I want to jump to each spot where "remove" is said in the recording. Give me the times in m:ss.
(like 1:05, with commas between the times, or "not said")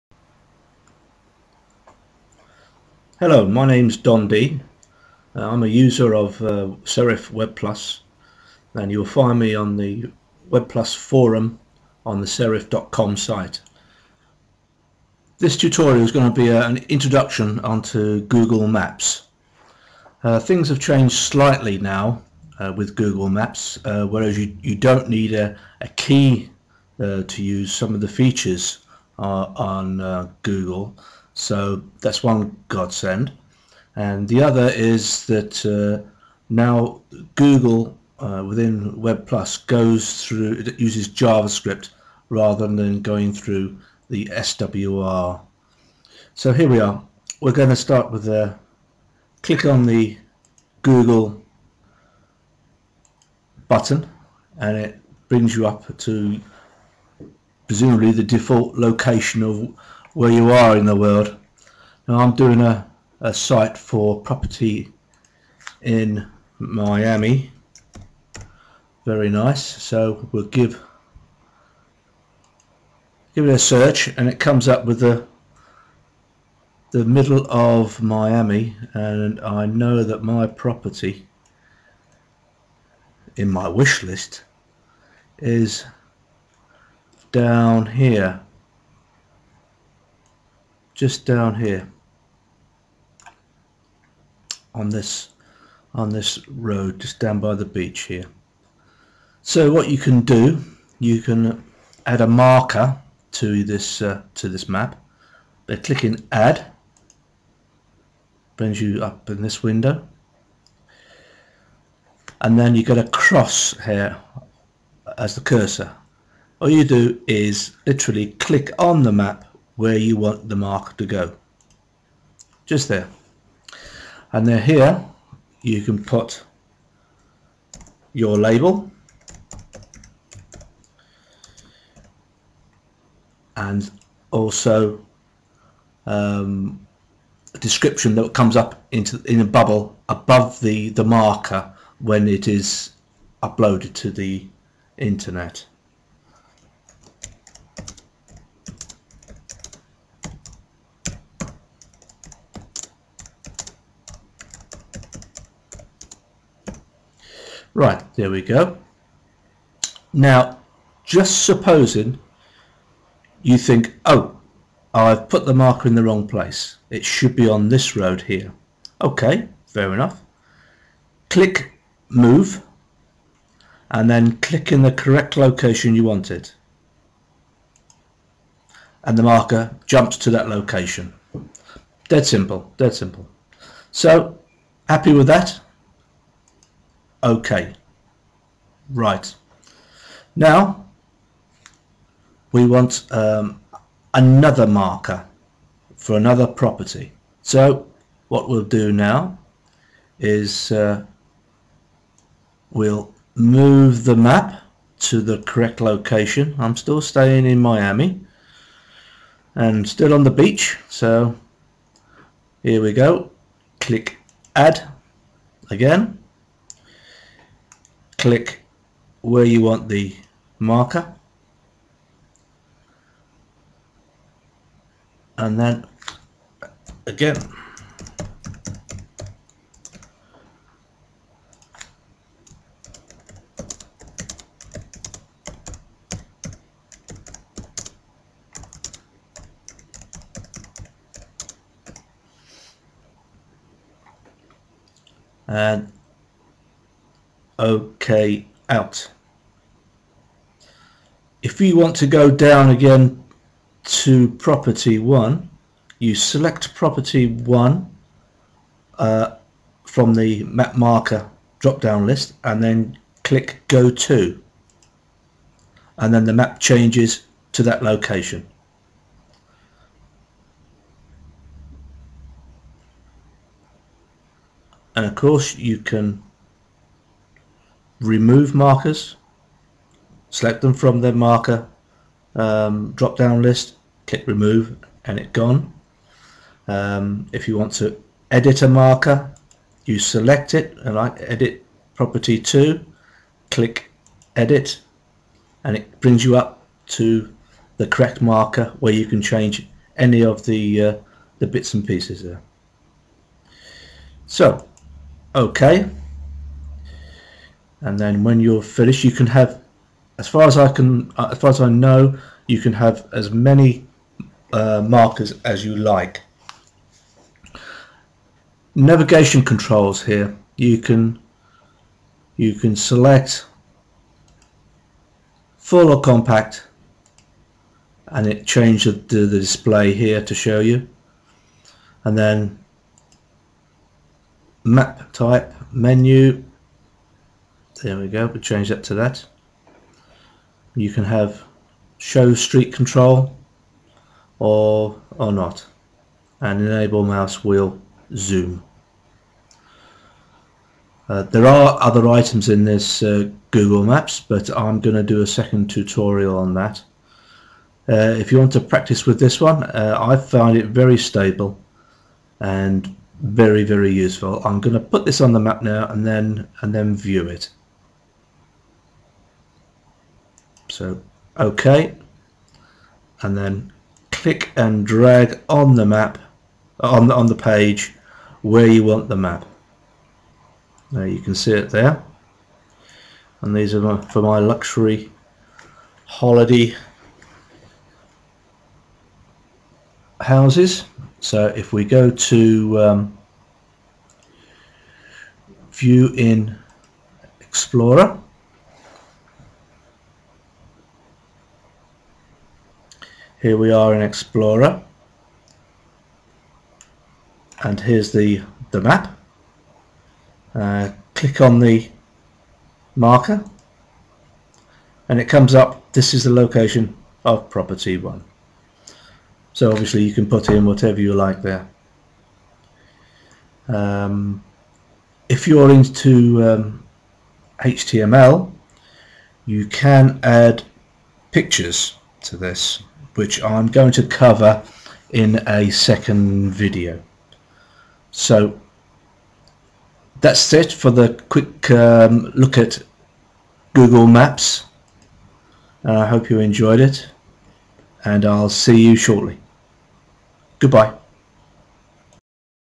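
4:38, 4:44.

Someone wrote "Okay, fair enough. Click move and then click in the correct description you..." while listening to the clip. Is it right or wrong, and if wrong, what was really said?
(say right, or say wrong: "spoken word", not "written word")
wrong: "location", not "description".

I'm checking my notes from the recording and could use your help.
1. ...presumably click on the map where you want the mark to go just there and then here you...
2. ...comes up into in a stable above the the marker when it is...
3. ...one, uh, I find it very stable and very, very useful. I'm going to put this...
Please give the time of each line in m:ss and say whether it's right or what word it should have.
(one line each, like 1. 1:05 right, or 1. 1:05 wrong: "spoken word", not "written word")
1. 1:57 wrong: "literally", not "presumably"
2. 2:18 wrong: "bubble", not "stable"
3. 5:59 right.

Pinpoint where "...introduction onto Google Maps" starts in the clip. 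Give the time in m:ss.
0:16.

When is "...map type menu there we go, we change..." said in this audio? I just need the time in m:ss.
5:34.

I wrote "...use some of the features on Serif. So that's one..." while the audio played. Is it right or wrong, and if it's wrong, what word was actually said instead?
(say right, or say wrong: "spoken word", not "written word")
wrong: "Google", not "Serif".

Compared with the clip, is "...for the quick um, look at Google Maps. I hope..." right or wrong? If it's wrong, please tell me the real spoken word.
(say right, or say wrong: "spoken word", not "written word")
right.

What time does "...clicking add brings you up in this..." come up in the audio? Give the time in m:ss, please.
1:45.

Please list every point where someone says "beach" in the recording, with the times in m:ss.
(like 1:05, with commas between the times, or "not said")
1:37, 3:30.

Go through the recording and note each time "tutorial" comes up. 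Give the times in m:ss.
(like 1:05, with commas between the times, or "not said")
0:15, 5:55.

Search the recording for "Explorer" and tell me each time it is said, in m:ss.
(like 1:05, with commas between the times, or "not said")
6:37, 6:44.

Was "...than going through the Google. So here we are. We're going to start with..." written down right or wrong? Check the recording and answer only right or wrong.
wrong.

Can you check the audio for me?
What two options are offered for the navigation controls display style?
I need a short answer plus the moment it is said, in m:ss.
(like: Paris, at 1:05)
Full or compact, at 5:25.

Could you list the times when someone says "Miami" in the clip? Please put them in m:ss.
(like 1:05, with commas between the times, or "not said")
1:06, 1:18, 3:27.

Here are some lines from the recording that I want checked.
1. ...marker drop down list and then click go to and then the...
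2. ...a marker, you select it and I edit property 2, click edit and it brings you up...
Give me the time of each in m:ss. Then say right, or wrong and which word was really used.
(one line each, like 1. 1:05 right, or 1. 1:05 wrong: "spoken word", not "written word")
1. 4:20 right
2. 4:48 right.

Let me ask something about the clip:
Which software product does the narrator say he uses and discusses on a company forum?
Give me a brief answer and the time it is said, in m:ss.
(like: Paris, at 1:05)
Serif Web Plus, at 0:06.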